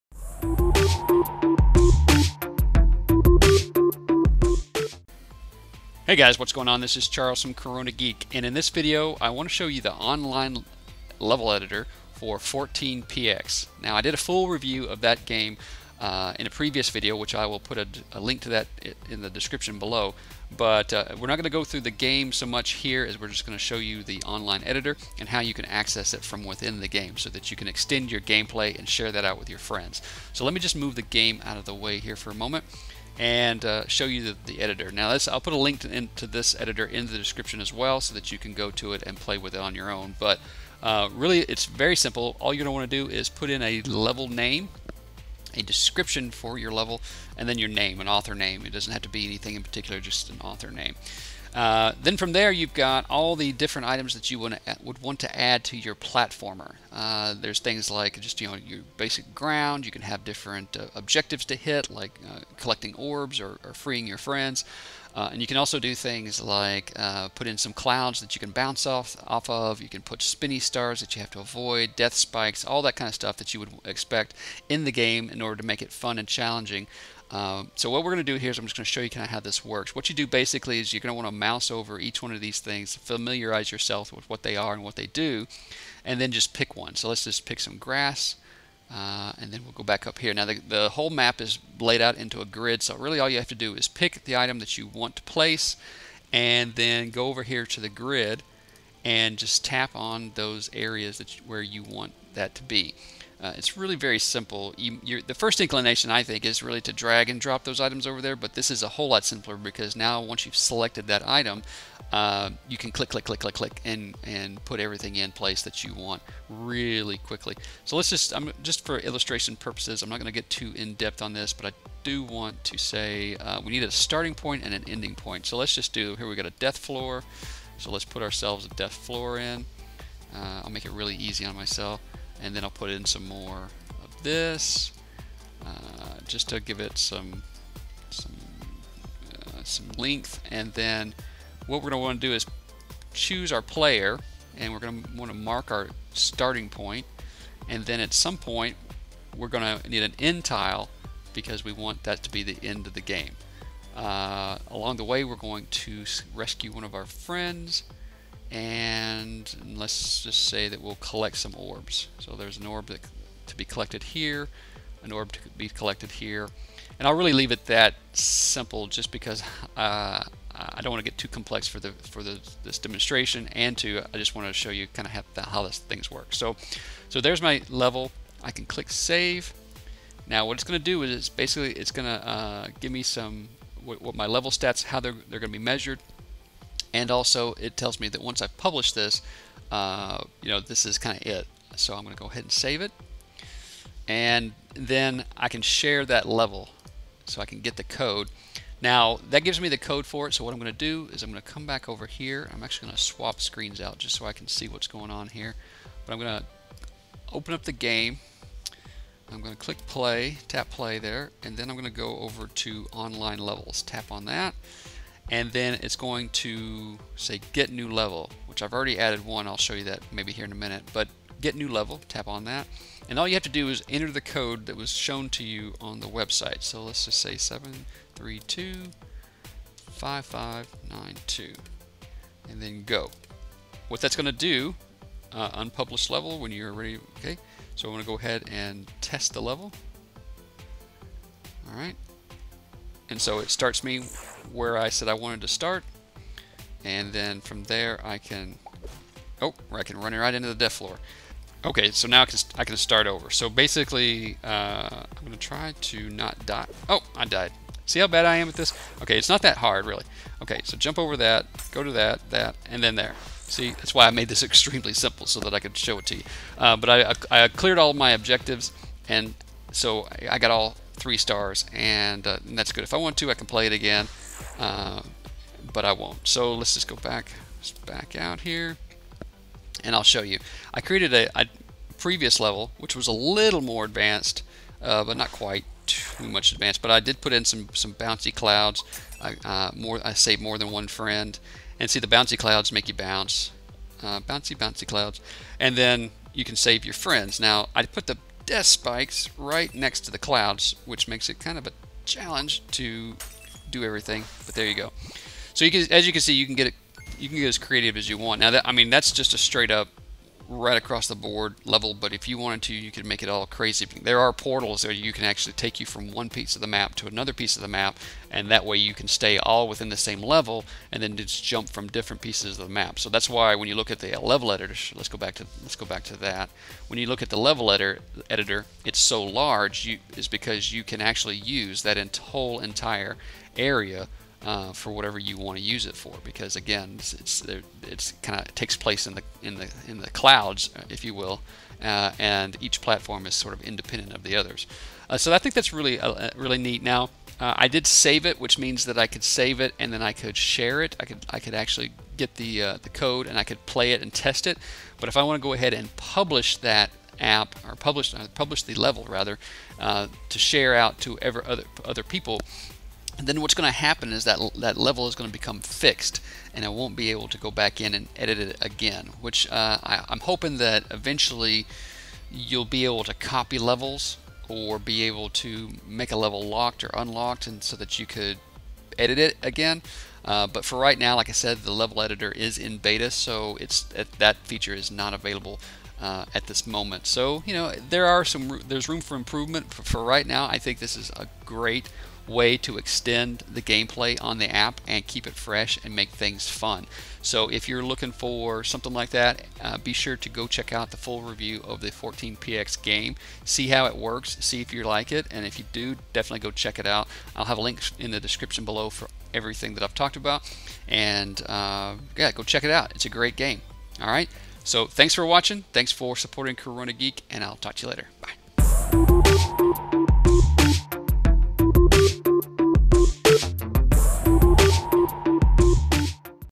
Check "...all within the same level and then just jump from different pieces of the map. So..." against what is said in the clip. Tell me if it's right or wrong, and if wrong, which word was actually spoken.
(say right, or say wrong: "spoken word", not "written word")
right.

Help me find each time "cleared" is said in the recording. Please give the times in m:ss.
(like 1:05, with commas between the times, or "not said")
4:27.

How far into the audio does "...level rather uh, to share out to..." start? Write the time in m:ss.
5:58.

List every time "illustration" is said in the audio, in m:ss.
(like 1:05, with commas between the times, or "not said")
1:58.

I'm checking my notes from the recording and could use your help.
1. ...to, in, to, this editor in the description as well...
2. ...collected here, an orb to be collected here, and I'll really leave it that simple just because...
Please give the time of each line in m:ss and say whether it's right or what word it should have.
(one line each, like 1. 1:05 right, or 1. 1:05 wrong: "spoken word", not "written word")
1. 0:35 right
2. 2:43 right.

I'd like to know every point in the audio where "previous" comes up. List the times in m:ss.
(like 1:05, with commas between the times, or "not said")
0:16, 4:41.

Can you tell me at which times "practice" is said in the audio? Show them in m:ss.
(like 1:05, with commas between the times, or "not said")
not said.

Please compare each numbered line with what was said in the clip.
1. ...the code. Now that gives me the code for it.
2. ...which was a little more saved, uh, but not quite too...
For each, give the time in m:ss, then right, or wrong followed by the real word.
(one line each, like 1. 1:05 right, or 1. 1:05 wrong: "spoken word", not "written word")
1. 3:17 right
2. 4:42 wrong: "advanced", not "saved".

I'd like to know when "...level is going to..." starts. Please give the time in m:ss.
6:04.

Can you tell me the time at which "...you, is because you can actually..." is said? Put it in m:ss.
5:29.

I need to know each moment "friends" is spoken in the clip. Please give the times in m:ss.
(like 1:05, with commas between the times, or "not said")
0:29, 1:04, 2:37, 4:50, 4:56.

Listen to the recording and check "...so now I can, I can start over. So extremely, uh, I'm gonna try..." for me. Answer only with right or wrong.
wrong.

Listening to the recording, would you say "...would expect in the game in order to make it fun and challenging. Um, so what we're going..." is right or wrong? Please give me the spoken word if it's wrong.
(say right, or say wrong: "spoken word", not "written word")
right.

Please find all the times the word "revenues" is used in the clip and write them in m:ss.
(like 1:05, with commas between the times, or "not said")
not said.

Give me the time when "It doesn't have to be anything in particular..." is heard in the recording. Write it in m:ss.
0:48.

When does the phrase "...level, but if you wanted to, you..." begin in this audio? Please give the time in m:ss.
5:11.